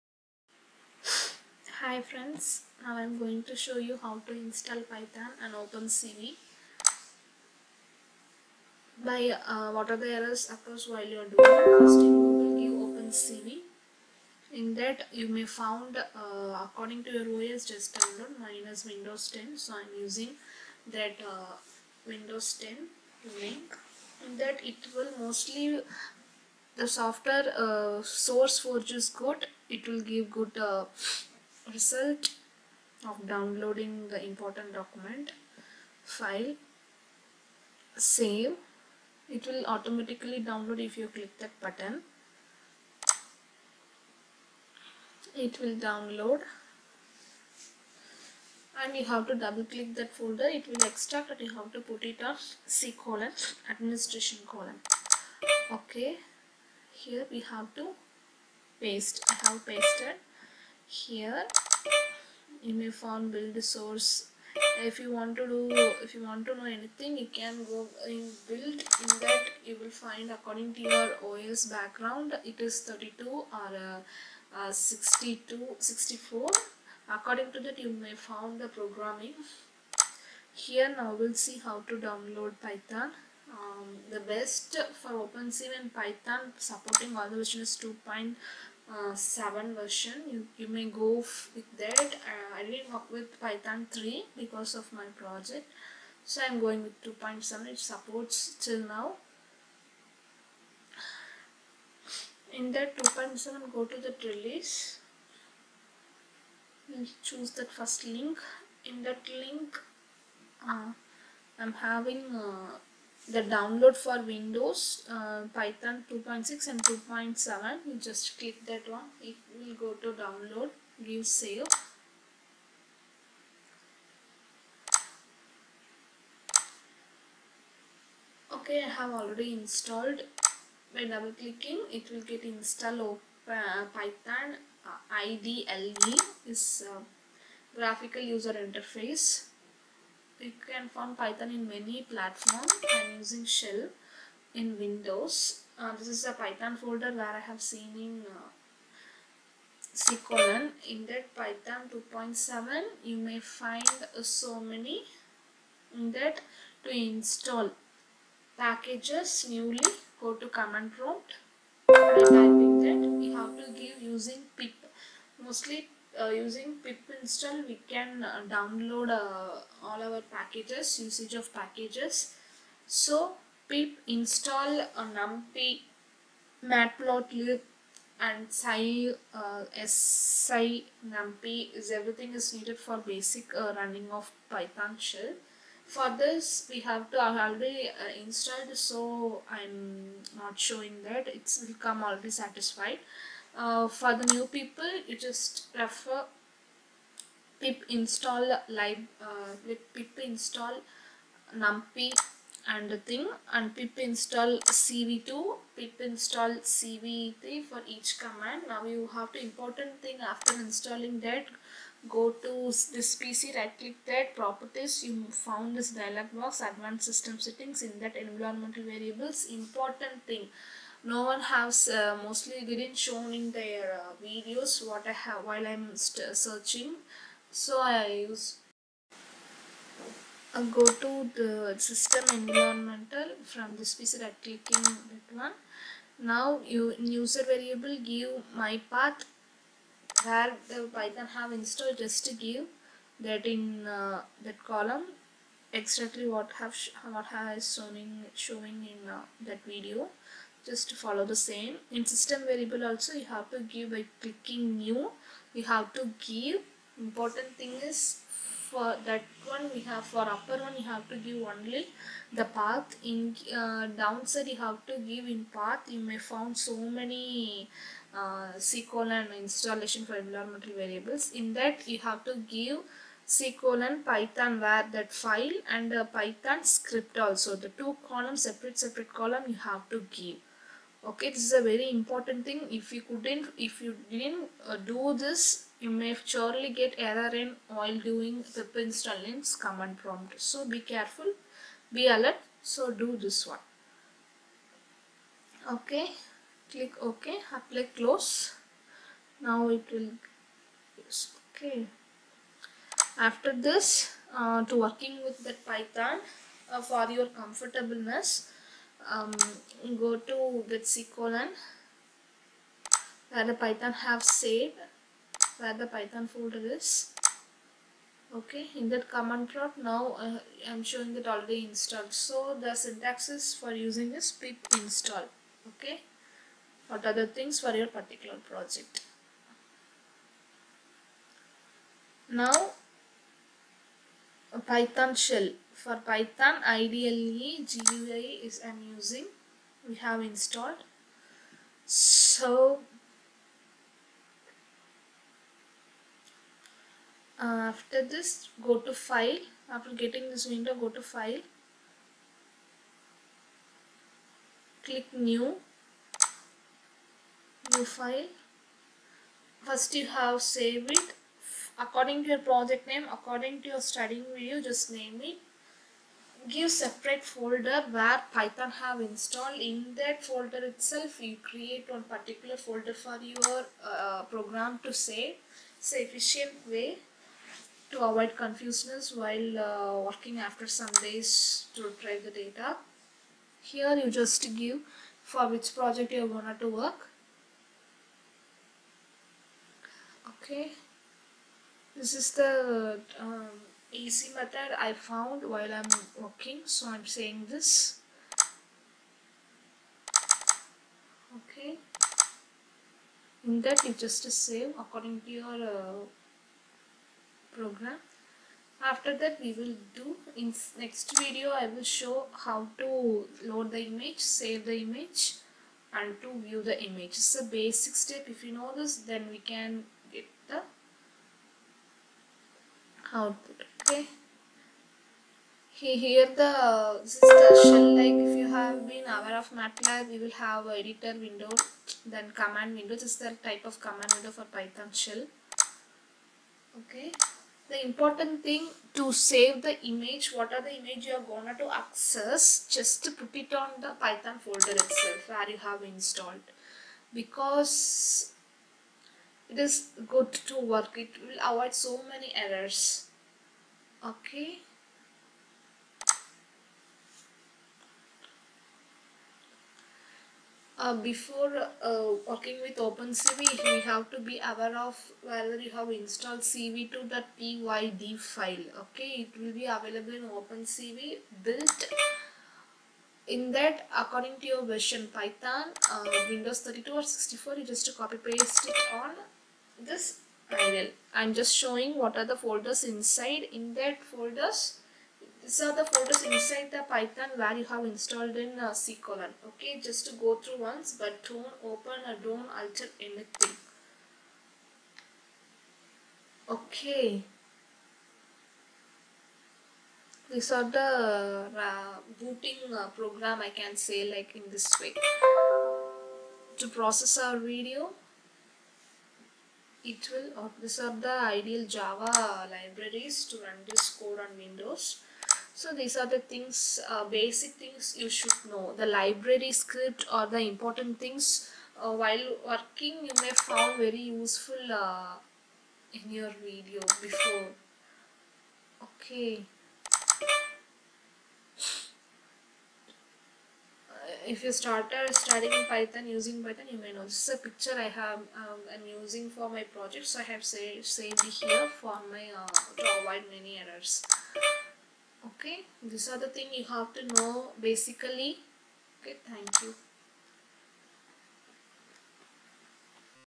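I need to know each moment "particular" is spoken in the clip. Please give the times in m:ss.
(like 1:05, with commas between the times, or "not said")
5:27, 6:12.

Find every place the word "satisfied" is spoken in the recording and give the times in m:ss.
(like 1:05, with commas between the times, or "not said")
3:12.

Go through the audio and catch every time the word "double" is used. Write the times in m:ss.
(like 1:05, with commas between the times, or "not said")
0:49, 2:11.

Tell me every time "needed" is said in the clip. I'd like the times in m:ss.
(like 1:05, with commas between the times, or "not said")
3:02.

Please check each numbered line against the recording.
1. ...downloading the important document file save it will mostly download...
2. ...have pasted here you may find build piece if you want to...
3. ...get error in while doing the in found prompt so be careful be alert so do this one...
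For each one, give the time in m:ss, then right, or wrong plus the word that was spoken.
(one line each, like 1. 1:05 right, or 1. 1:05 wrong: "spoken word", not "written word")
1. 0:33 wrong: "automatically", not "mostly"
2. 0:59 wrong: "source", not "piece"
3. 4:46 wrong: "command", not "found".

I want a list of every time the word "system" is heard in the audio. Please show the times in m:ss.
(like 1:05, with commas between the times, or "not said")
3:37, 3:51, 4:12.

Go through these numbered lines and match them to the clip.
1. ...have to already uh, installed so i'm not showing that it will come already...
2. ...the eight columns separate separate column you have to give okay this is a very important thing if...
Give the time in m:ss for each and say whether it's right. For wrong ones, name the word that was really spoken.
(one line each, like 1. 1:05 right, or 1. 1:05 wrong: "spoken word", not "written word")
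1. 3:06 right
2. 4:37 wrong: "two", not "eight".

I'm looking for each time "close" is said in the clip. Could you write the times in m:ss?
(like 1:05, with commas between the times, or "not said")
4:57.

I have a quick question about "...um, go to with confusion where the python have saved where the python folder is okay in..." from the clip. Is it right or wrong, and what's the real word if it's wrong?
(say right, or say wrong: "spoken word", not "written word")
wrong: "colon", not "confusion".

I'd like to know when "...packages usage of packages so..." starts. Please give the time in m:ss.
2:50.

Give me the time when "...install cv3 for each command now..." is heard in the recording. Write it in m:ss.
3:25.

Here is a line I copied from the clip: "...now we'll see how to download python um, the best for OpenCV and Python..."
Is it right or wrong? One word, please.
right.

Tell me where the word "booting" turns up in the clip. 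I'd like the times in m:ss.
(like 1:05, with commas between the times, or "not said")
8:22.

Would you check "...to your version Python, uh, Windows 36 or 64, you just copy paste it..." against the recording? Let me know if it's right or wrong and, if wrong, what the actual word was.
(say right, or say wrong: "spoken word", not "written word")
wrong: "32", not "36".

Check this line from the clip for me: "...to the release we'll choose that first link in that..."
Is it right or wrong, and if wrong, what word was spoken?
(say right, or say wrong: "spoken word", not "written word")
right.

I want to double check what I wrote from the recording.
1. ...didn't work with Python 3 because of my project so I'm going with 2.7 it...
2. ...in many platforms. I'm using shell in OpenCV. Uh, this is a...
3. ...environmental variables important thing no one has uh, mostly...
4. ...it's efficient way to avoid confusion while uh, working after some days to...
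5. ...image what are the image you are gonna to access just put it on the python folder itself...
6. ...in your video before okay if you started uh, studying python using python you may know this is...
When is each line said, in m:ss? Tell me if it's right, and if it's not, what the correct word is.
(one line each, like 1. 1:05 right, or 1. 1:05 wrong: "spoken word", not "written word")
1. 1:32 right
2. 2:21 wrong: "Windows", not "OpenCV"
3. 3:38 right
4. 6:15 right
5. 7:19 right
6. 8:45 right.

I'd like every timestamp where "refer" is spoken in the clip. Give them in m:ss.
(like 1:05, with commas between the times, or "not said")
3:15.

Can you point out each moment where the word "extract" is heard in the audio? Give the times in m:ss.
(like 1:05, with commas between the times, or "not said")
0:50.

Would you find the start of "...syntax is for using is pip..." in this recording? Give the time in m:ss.
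5:22.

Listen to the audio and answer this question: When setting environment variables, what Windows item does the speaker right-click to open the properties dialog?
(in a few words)
This PC.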